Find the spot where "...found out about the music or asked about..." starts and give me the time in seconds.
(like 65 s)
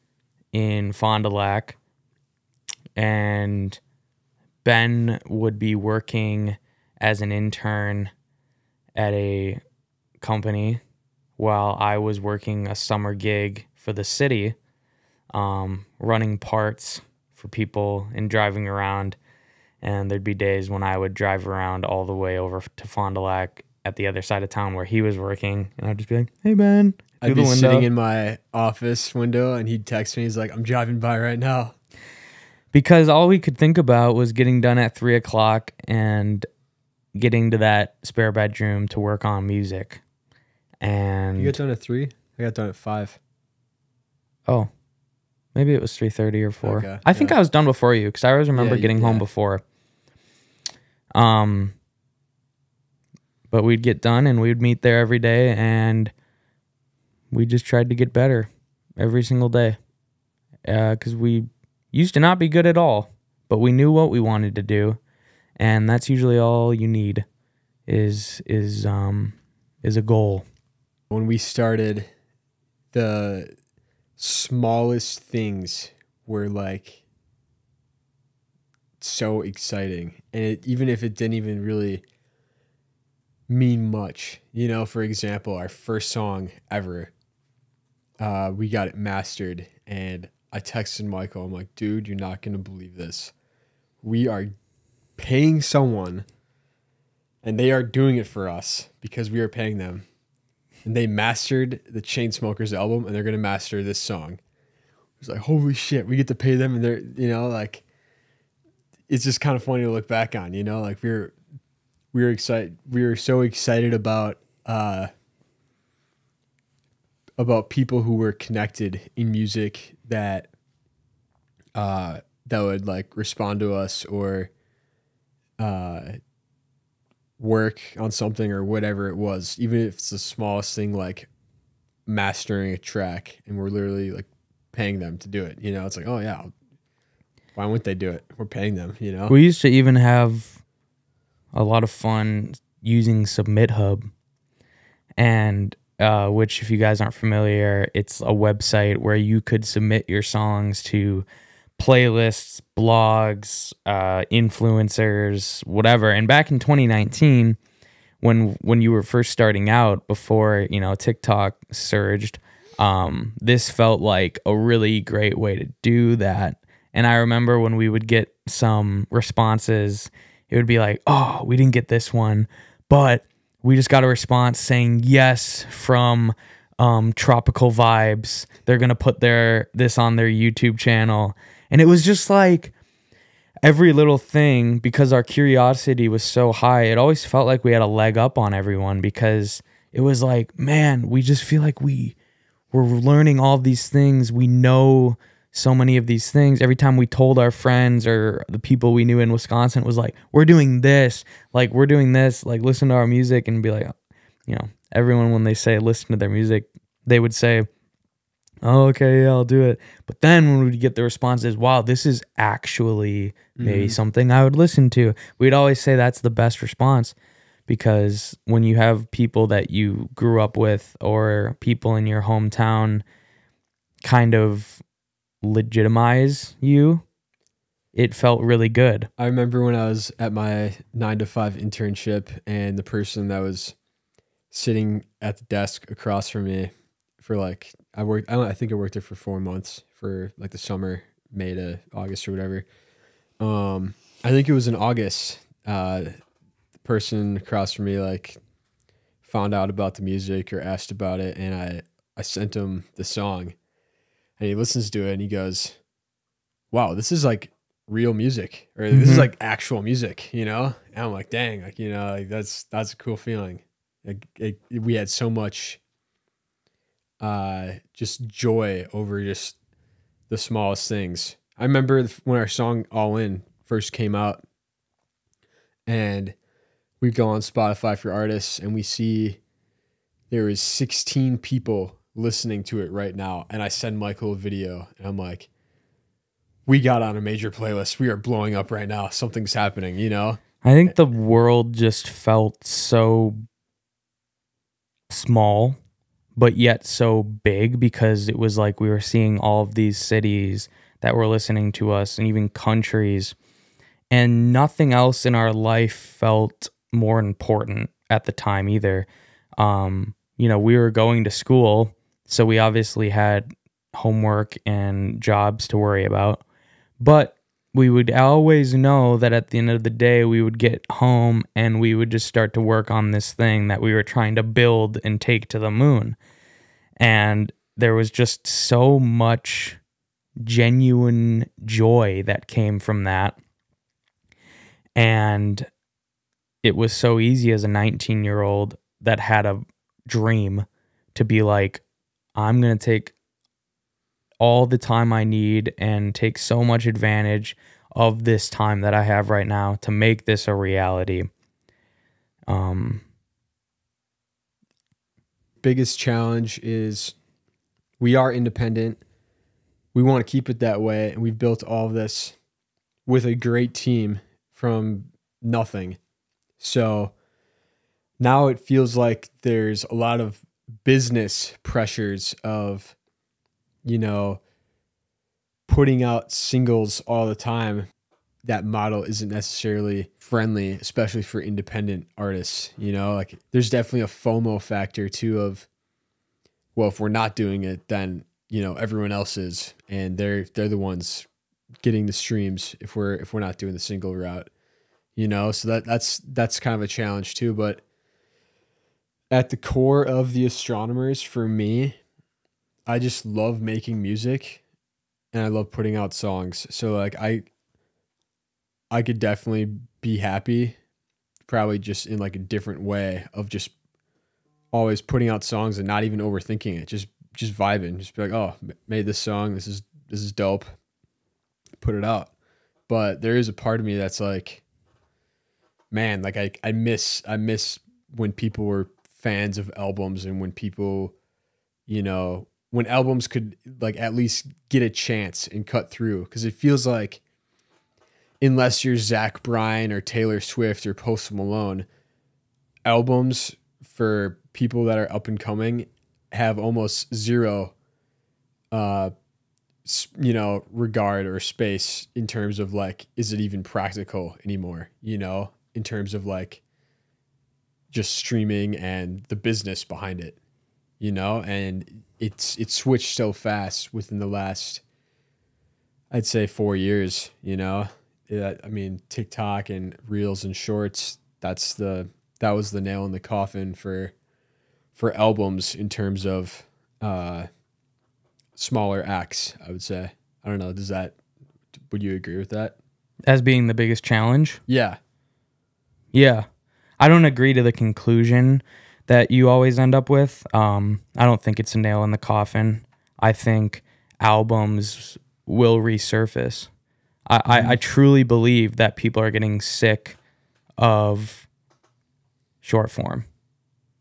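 249 s.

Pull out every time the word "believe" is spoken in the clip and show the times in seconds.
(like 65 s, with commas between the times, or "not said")
92 s, 498 s.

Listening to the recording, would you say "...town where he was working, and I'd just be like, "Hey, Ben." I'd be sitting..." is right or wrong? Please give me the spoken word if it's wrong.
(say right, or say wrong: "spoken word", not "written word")
right.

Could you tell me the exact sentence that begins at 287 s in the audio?
We are blowing up right now.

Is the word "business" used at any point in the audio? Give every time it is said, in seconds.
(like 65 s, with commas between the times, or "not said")
370 s, 459 s.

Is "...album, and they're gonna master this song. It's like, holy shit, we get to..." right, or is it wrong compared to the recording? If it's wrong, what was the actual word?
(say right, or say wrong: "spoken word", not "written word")
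right.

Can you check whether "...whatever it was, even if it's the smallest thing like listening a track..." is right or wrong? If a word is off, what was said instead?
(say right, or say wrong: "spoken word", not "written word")
wrong: "mastering", not "listening".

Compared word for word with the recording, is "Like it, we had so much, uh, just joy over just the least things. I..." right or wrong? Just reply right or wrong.
wrong.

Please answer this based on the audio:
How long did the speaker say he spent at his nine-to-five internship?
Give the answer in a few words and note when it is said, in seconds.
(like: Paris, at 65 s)
4 months, at 239 s.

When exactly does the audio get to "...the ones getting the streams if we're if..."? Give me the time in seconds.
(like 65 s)
390 s.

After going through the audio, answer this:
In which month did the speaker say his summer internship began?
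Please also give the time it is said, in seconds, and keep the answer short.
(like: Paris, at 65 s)
May, at 241 s.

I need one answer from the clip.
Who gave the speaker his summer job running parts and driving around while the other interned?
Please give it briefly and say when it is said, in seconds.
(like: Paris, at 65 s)
the city, at 13 s.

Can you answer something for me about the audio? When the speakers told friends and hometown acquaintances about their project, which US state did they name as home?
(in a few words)
Wisconsin.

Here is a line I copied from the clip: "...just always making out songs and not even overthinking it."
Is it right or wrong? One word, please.
wrong.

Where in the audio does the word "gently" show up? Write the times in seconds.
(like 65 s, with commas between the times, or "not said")
not said.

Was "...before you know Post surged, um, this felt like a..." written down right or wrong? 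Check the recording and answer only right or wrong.
wrong.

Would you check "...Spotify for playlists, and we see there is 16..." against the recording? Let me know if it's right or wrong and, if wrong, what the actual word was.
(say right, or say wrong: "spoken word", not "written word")
wrong: "artists", not "playlists".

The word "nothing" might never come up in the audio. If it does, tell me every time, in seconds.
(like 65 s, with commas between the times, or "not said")
304 s, 365 s.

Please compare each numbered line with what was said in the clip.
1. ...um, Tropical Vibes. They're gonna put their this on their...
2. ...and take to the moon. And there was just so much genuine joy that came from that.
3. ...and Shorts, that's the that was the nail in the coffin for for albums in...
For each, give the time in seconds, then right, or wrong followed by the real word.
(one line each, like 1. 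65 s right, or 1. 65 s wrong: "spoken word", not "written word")
1. 176 s right
2. 325 s right
3. 470 s right.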